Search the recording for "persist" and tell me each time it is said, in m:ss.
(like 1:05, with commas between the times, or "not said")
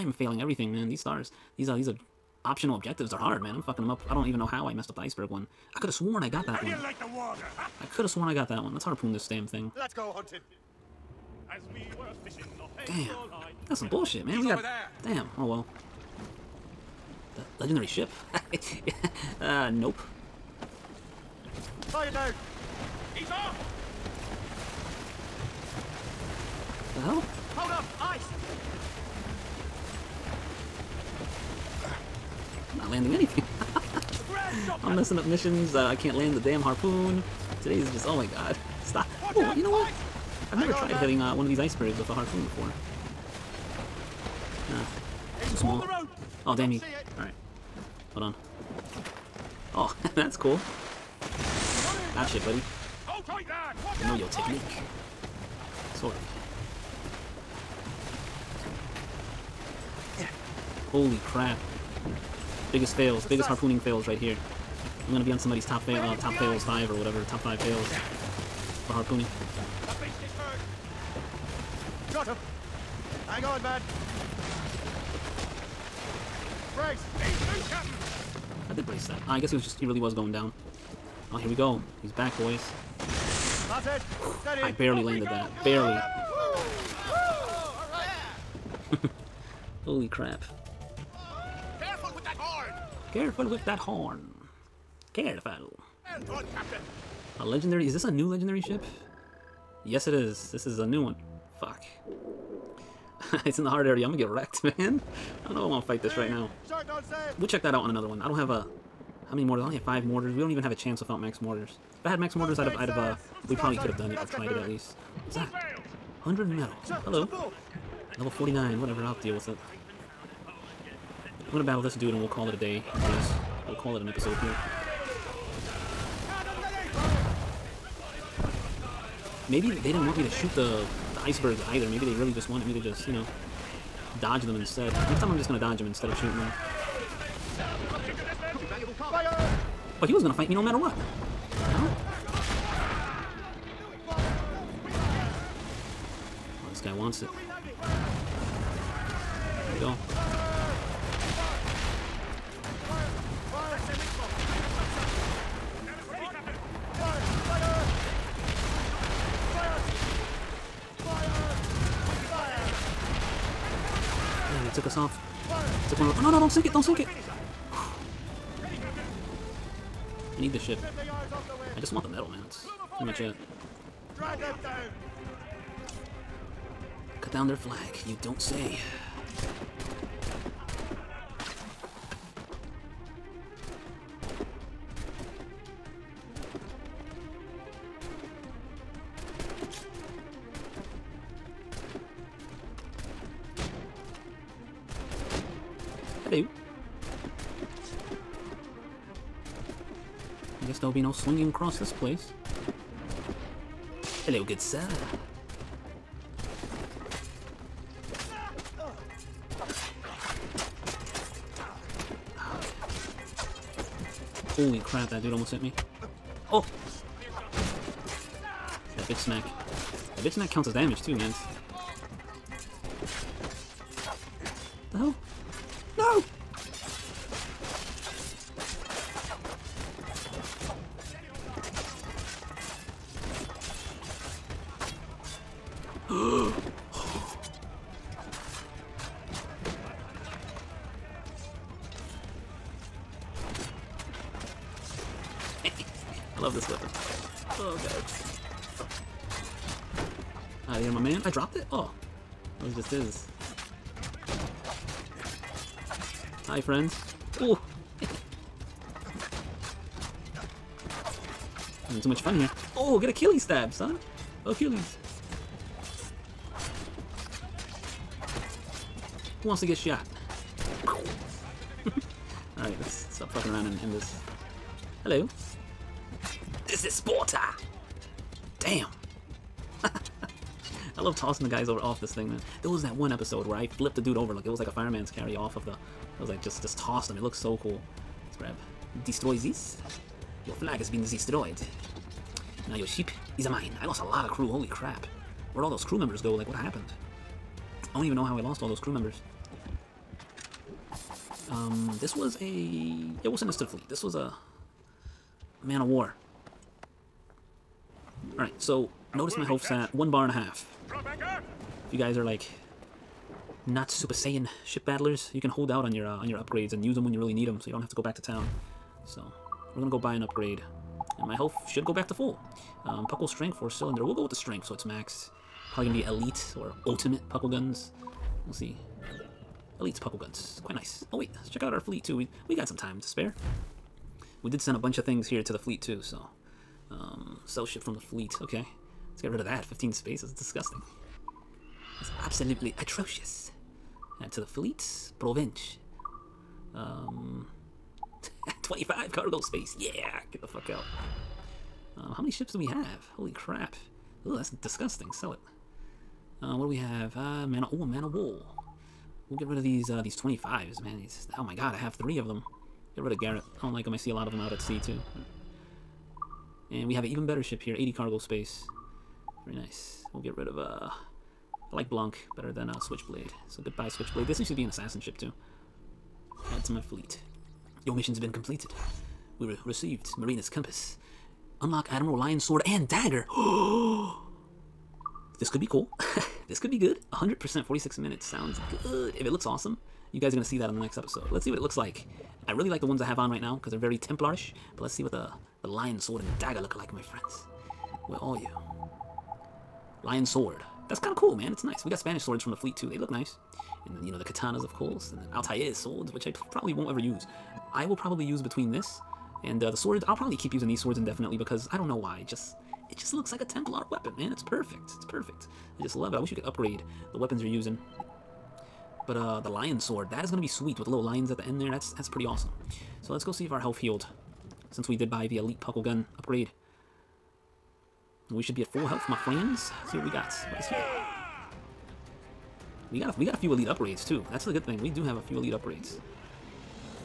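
not said.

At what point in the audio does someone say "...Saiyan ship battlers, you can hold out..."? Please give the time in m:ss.
5:14.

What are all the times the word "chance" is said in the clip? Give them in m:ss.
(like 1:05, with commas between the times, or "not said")
1:50.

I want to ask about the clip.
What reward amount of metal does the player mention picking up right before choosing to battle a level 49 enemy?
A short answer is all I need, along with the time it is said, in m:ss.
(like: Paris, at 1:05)
100, at 1:56.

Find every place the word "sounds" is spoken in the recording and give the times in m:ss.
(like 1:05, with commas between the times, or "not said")
6:28.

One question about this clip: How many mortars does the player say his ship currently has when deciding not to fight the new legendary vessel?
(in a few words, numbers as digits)
5.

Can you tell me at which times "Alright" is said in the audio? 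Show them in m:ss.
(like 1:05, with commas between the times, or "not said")
0:47, 4:31, 5:08.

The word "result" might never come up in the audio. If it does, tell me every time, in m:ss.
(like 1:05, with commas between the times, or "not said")
not said.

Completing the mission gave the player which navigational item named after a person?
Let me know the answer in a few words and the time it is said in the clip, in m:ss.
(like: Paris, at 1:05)
Marina's compass, at 6:20.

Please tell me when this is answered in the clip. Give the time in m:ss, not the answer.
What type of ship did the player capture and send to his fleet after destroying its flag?
5:05.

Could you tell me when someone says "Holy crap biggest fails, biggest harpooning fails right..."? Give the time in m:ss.
1:00.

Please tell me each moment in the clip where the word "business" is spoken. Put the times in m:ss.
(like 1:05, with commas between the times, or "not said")
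not said.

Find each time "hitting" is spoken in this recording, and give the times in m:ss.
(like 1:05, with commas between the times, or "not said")
0:41.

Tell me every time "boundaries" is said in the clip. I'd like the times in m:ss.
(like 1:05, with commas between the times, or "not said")
not said.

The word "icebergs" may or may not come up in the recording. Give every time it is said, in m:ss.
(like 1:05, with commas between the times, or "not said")
0:04, 0:41, 2:11.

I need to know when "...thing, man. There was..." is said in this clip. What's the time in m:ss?
4:42.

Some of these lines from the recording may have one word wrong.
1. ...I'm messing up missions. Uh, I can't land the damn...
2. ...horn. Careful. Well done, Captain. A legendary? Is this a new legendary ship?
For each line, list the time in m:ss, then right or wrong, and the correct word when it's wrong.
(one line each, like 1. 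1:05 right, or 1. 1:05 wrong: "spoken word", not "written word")
1. 0:34 right
2. 1:33 right.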